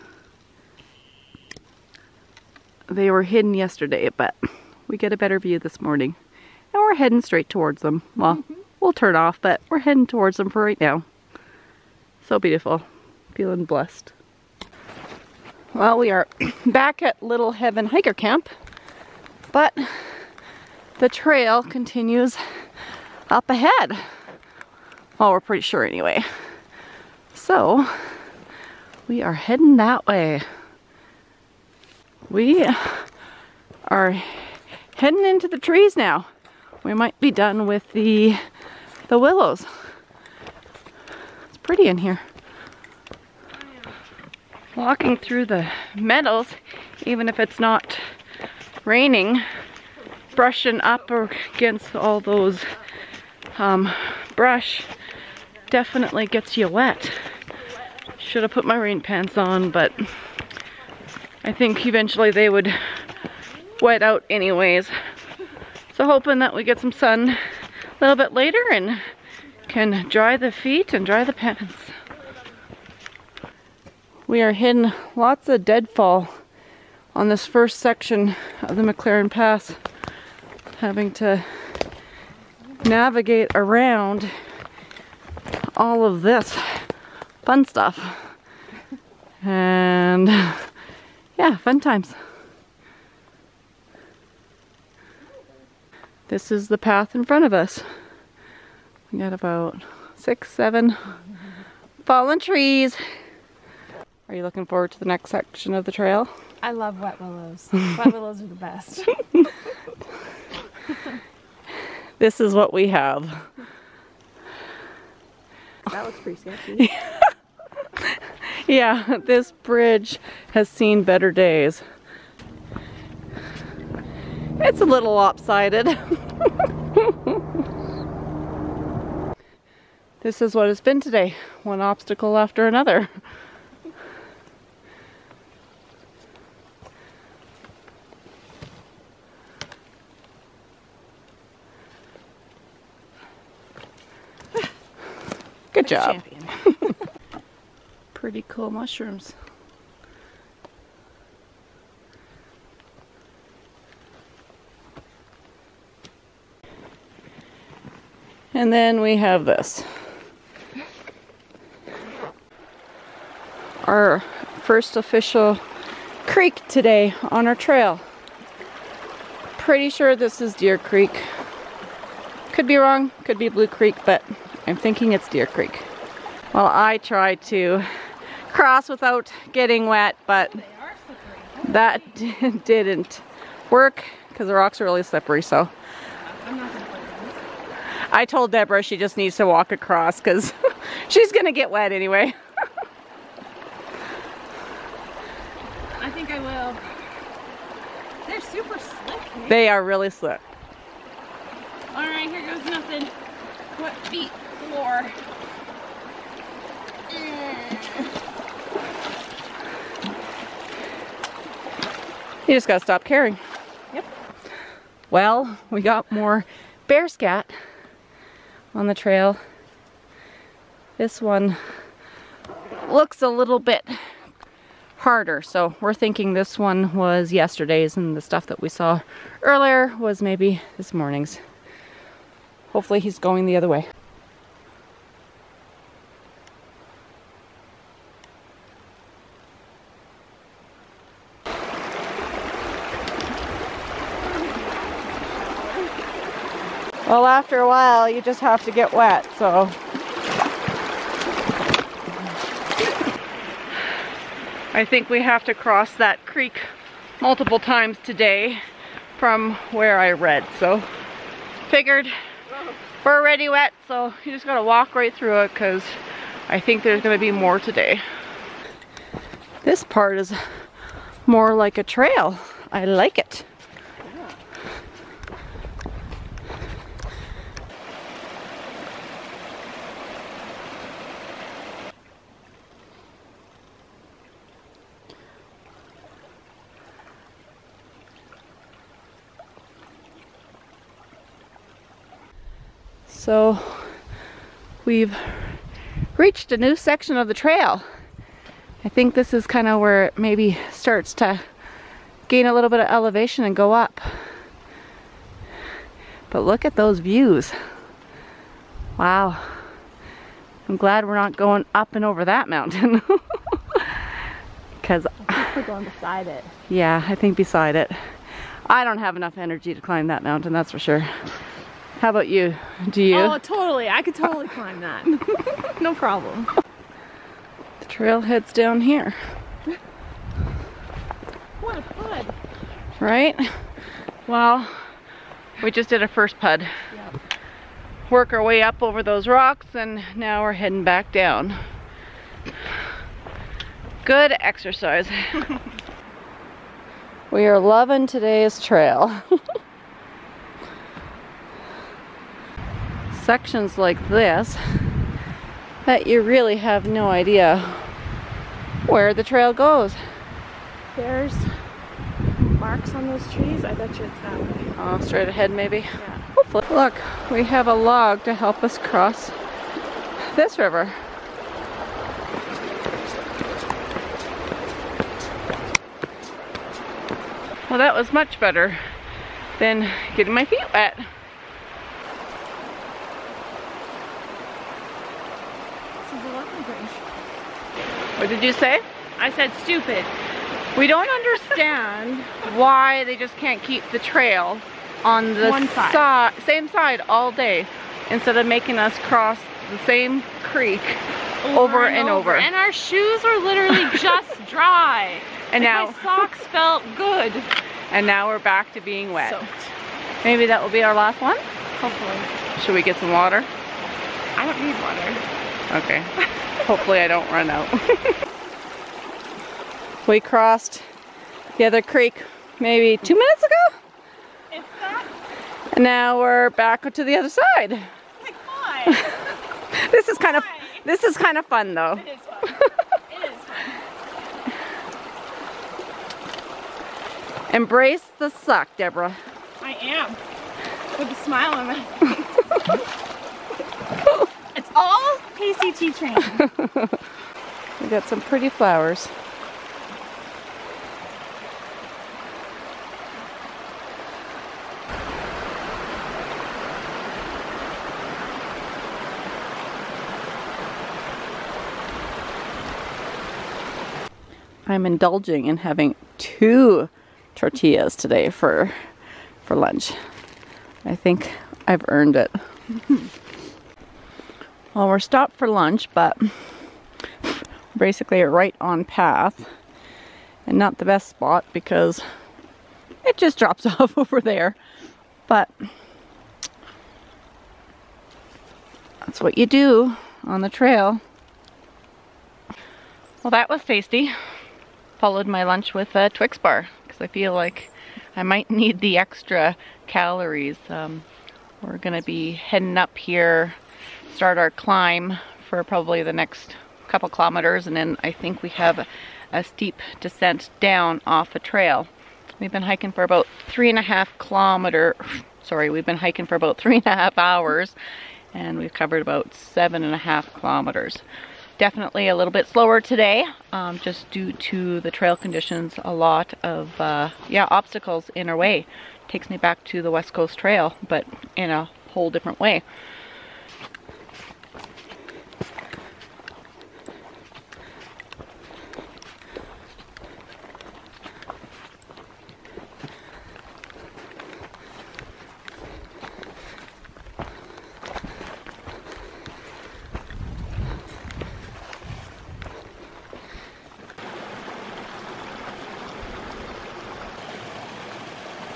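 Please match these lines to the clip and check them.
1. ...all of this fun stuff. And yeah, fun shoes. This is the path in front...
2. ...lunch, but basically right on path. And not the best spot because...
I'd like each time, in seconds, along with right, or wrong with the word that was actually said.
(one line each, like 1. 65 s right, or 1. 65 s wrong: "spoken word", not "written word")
1. 85 s wrong: "times", not "shoes"
2. 475 s right.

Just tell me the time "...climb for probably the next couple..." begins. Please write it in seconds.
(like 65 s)
504 s.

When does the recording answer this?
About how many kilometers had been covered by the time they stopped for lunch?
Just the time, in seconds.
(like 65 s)
519 s.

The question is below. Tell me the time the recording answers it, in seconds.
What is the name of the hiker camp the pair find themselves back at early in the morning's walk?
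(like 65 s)
17 s.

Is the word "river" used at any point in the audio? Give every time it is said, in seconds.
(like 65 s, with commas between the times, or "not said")
370 s.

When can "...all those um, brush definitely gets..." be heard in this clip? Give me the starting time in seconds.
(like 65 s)
51 s.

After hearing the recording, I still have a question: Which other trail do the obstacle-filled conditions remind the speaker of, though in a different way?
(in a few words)
West Coast Trail.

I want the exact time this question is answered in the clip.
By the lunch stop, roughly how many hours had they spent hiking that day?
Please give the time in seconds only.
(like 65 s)
516 s.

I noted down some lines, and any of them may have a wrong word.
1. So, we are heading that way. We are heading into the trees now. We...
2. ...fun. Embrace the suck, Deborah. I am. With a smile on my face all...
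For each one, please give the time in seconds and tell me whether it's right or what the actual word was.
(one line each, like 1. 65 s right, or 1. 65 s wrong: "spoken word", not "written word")
1. 27 s right
2. 437 s right.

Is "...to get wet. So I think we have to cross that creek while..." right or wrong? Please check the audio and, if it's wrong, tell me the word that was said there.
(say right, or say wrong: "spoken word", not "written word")
wrong: "multiple", not "while".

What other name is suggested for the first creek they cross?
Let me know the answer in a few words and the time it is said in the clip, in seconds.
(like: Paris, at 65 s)
Blue Creek, at 173 s.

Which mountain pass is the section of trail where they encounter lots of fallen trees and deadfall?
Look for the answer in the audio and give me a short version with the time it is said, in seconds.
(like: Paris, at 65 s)
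McLaren Pass, at 78 s.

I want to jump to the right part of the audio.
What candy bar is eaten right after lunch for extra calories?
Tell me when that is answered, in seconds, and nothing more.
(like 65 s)
496 s.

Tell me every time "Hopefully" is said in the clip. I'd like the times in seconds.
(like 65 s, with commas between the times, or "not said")
232 s, 366 s, 411 s, 416 s.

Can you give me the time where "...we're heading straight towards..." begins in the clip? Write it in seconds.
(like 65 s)
6 s.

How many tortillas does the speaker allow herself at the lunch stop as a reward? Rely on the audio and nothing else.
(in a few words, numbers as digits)
2.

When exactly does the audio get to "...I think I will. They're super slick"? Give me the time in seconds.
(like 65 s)
195 s.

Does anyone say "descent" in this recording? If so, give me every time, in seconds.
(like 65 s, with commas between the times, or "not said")
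509 s.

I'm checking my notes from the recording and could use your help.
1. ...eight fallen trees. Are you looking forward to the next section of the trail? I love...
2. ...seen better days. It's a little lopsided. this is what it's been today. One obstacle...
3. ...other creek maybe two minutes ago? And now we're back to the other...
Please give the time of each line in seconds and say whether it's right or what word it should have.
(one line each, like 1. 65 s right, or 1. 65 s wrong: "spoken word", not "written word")
1. 100 s wrong: "seven", not "eight"
2. 120 s right
3. 421 s right.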